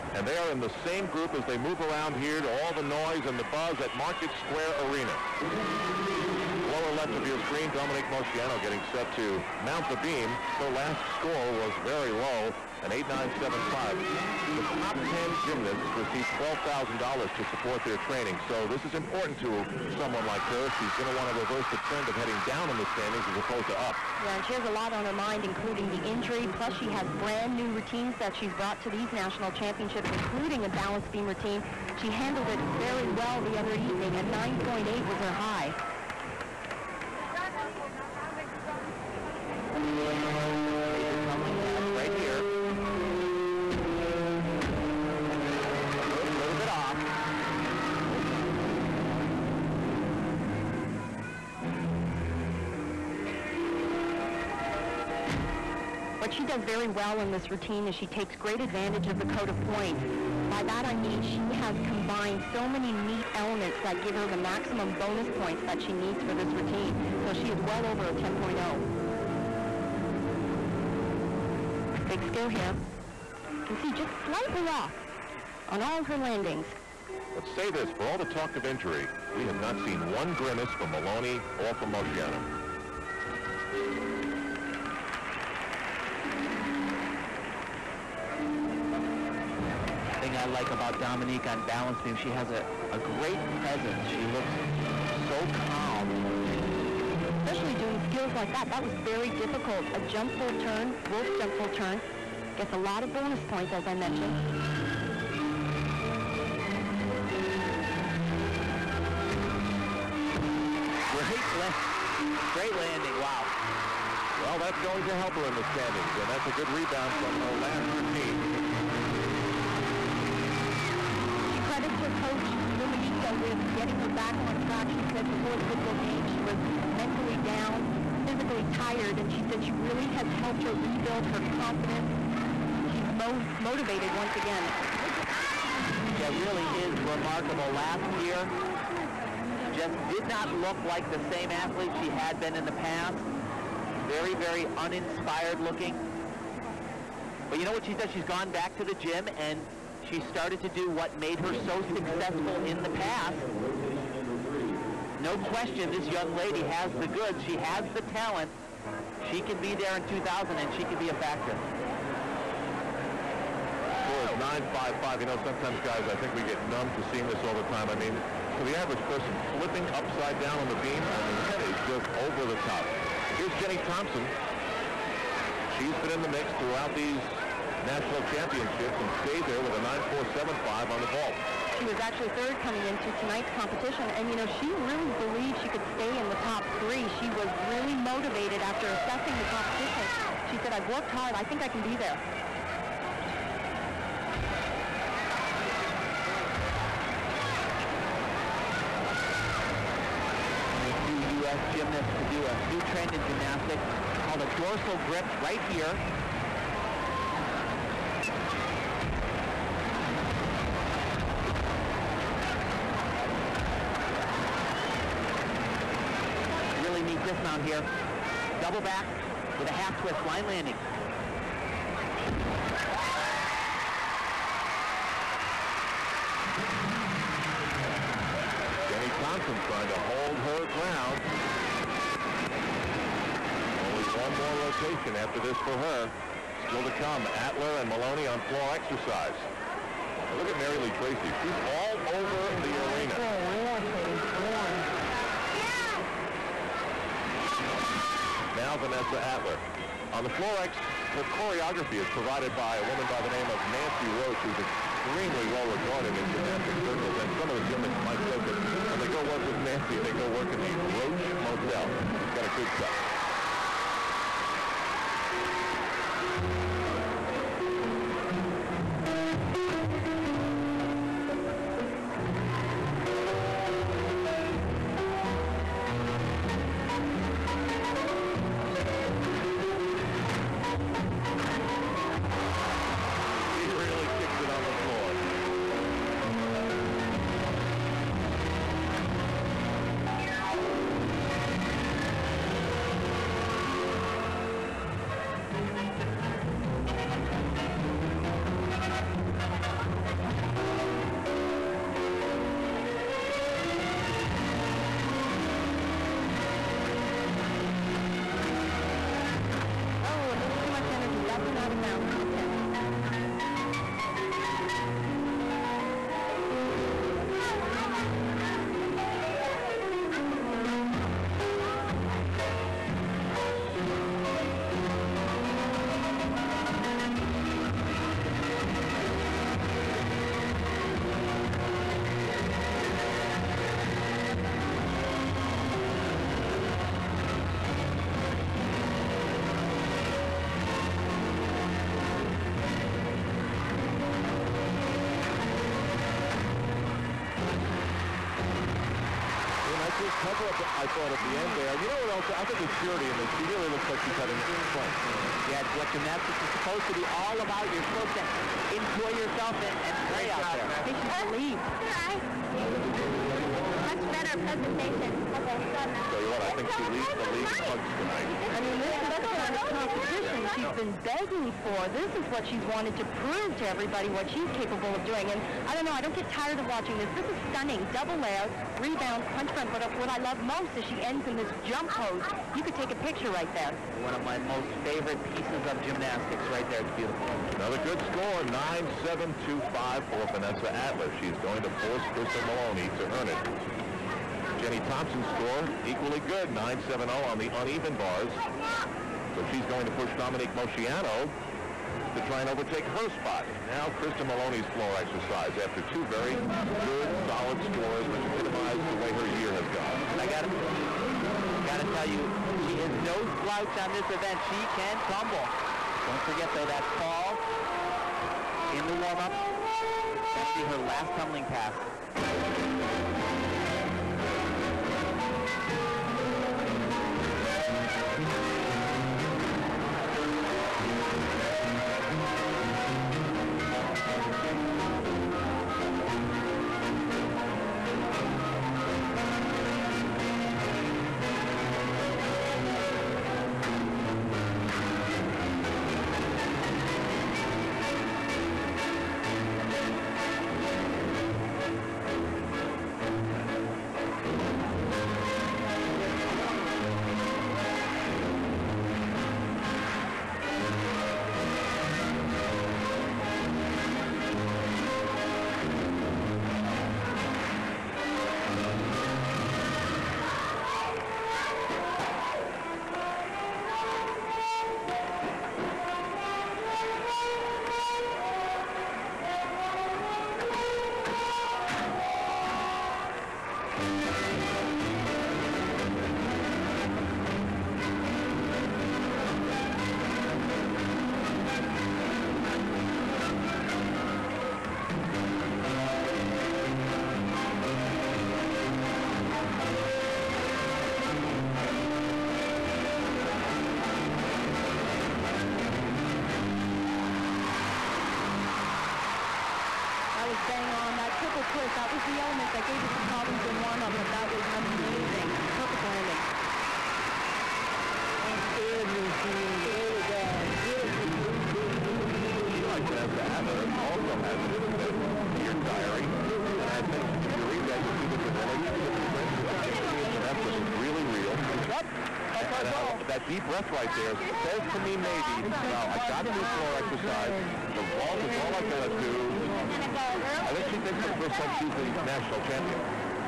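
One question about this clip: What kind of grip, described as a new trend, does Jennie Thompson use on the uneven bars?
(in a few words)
dorsal grip.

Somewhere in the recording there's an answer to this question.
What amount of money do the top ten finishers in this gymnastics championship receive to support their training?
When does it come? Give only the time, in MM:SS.
00:16.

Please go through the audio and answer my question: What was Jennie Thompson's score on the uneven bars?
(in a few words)
9.70.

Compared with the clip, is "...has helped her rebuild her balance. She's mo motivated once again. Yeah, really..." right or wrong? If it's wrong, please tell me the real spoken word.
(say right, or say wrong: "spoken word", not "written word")
wrong: "confidence", not "balance".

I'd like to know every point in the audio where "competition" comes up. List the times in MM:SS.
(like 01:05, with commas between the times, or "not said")
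03:03, 03:09, 06:09.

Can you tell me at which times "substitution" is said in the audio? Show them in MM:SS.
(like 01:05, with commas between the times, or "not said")
not said.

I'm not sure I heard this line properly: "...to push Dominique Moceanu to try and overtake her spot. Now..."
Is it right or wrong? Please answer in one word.
right.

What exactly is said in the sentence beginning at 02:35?
No question, this young lady has the goods.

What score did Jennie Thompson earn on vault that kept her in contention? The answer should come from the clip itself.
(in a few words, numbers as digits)
9.475.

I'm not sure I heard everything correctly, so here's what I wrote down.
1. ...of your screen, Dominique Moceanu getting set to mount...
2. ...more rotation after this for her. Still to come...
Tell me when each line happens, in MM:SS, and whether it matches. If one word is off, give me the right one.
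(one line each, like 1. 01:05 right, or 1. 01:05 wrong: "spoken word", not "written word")
1. 00:07 right
2. 03:54 right.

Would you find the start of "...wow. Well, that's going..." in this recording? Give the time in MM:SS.
01:53.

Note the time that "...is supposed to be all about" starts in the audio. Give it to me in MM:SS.
05:56.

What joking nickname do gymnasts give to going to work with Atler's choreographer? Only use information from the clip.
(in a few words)
the Roach Motel.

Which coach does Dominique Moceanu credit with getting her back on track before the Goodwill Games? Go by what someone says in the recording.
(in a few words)
Luminita.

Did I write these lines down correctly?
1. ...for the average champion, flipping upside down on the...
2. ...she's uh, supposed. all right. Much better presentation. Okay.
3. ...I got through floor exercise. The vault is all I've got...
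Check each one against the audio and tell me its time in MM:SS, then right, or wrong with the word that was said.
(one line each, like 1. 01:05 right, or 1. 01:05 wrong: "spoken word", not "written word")
1. 02:48 wrong: "person", not "champion"
2. 06:00 wrong: "relieved", not "supposed"
3. 08:55 right.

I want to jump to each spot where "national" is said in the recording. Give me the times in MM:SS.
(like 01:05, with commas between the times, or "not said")
00:29, 02:57, 09:02.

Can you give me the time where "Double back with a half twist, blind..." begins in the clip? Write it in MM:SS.
03:38.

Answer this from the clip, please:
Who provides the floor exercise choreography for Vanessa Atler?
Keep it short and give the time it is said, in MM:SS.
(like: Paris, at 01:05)
Nancy Roach, at 04:13.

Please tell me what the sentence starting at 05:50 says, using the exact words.
cover-up, I thought, at the end there.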